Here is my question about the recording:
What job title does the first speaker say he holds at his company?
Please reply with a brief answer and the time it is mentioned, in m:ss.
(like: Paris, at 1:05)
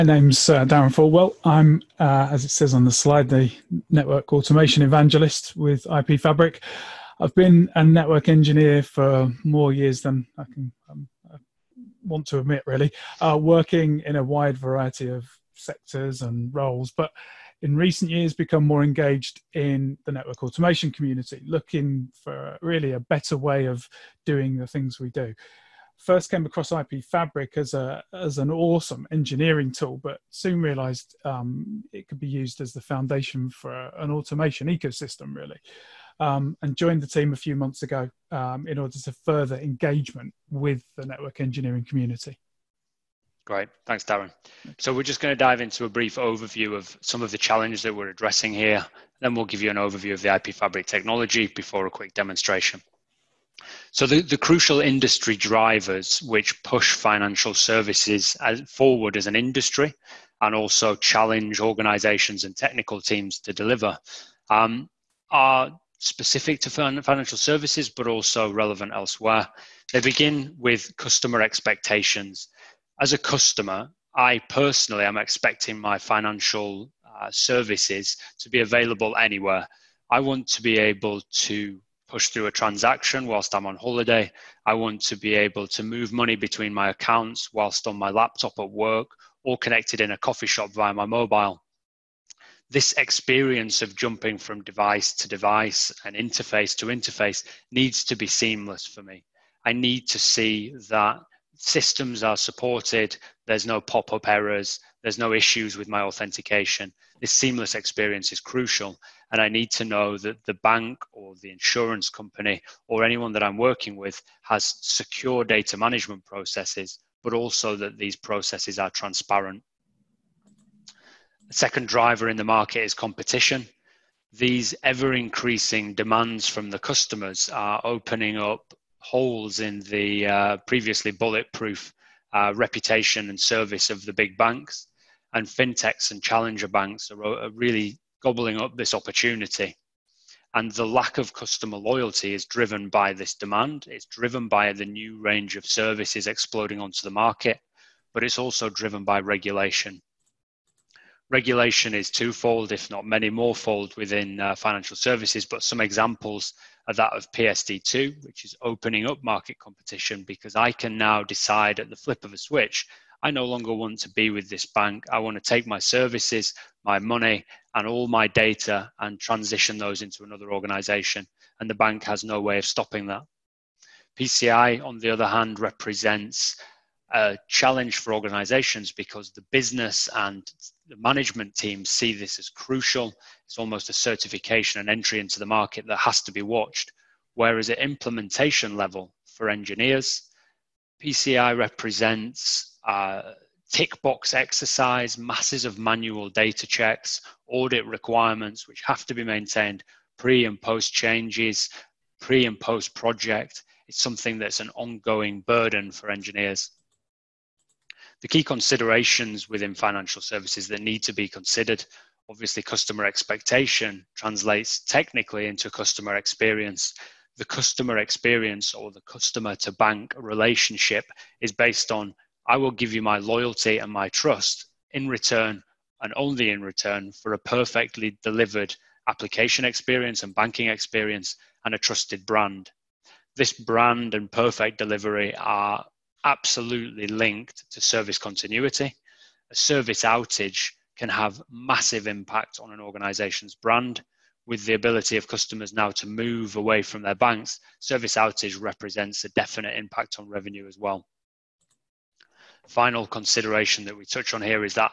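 Network automation evangelist, at 0:03.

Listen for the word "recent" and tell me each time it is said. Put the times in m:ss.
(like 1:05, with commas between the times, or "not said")
0:17.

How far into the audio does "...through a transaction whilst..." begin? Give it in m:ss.
1:22.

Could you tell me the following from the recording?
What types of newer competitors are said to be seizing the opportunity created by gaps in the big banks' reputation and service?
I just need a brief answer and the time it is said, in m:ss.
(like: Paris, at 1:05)
Fintechs and challenger banks, at 2:15.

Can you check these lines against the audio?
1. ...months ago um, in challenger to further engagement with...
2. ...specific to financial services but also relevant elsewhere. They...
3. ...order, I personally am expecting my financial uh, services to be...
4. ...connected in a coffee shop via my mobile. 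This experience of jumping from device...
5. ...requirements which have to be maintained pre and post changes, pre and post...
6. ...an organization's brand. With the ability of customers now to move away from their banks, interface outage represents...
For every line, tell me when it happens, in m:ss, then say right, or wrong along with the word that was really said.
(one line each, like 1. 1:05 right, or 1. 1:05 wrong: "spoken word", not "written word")
1. 0:37 wrong: "order", not "challenger"
2. 1:05 right
3. 1:13 wrong: "customer", not "order"
4. 1:29 right
5. 3:17 right
6. 4:02 wrong: "service", not "interface".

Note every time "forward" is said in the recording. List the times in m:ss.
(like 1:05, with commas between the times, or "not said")
0:58.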